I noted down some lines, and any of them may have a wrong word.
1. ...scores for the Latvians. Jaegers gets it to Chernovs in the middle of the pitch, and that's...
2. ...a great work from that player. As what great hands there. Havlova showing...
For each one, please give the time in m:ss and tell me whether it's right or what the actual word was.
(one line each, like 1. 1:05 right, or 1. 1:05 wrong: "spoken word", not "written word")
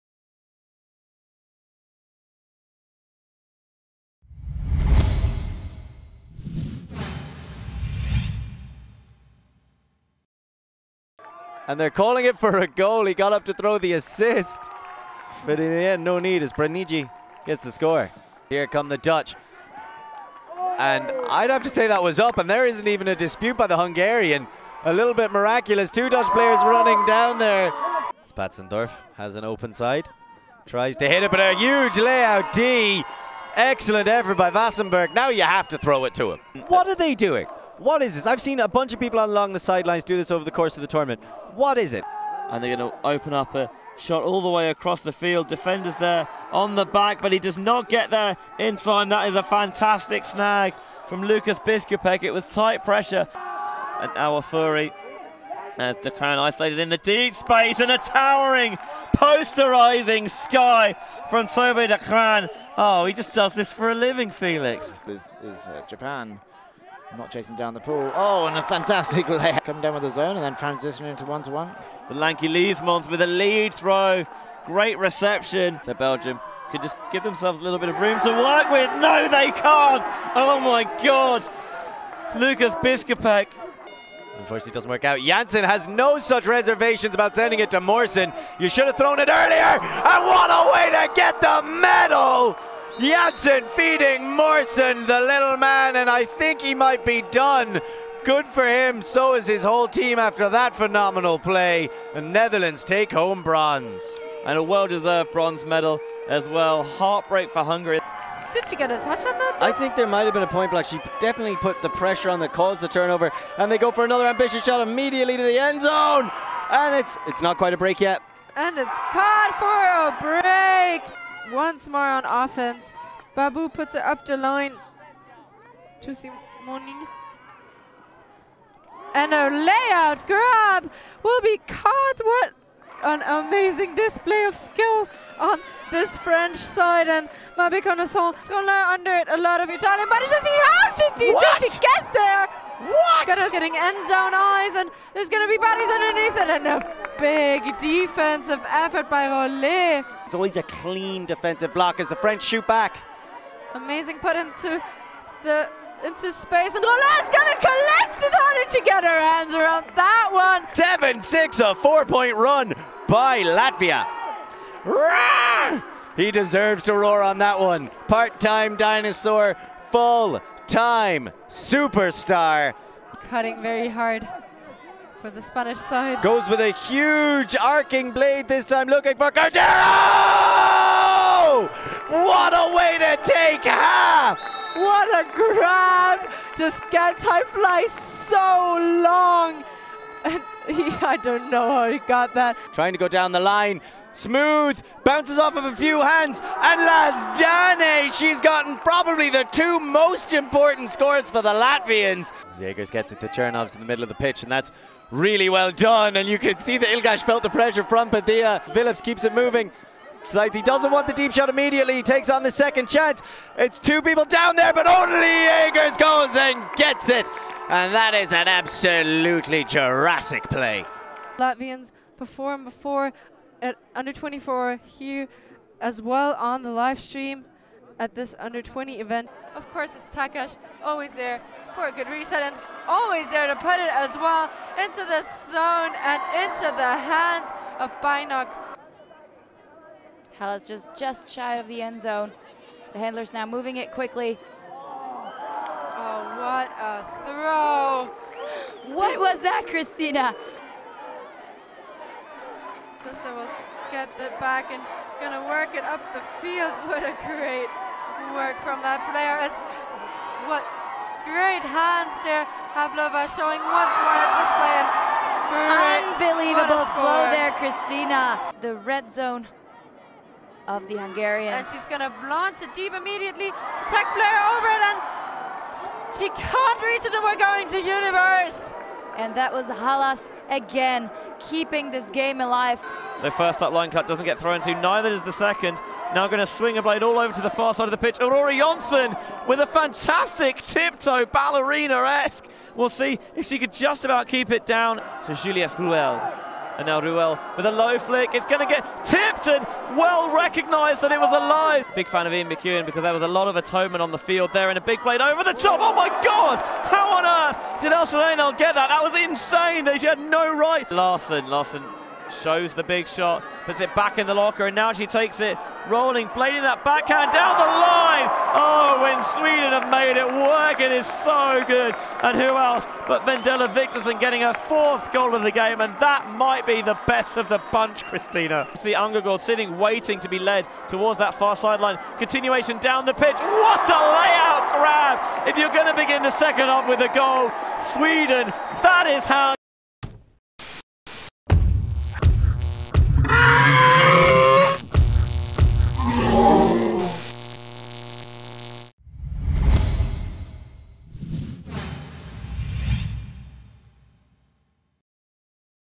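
1. 3:20 right
2. 4:17 right.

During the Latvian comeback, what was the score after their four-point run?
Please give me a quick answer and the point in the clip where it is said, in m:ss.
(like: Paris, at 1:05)
7-6, at 2:41.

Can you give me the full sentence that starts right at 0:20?
And I'd have to say that was up, and there isn't even a dispute by the Hungarian.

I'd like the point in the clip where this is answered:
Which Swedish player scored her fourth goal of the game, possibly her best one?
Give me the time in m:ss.
5:23.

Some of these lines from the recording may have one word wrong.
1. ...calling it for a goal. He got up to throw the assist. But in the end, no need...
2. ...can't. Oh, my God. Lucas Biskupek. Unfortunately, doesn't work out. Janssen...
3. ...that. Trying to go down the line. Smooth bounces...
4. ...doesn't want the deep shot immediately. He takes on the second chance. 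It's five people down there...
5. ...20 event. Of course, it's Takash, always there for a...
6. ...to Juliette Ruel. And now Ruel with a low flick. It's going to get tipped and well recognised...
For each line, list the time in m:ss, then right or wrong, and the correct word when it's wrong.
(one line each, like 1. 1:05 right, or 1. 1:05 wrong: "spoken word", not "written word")
1. 0:11 right
2. 1:19 right
3. 3:12 right
4. 3:30 wrong: "two", not "five"
5. 3:48 right
6. 4:55 right.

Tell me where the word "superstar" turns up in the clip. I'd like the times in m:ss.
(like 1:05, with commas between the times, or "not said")
2:51.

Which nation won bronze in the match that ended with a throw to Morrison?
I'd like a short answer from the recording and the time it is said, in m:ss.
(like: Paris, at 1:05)
The Netherlands, at 1:42.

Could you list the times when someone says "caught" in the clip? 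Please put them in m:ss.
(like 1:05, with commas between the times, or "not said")
1:59, 2:11.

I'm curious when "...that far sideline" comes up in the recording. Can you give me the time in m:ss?
5:31.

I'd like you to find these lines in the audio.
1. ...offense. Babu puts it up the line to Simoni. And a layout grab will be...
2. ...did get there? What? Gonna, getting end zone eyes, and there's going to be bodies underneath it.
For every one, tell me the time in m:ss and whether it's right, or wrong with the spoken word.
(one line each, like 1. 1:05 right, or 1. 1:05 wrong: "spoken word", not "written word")
1. 2:02 right
2. 2:21 right.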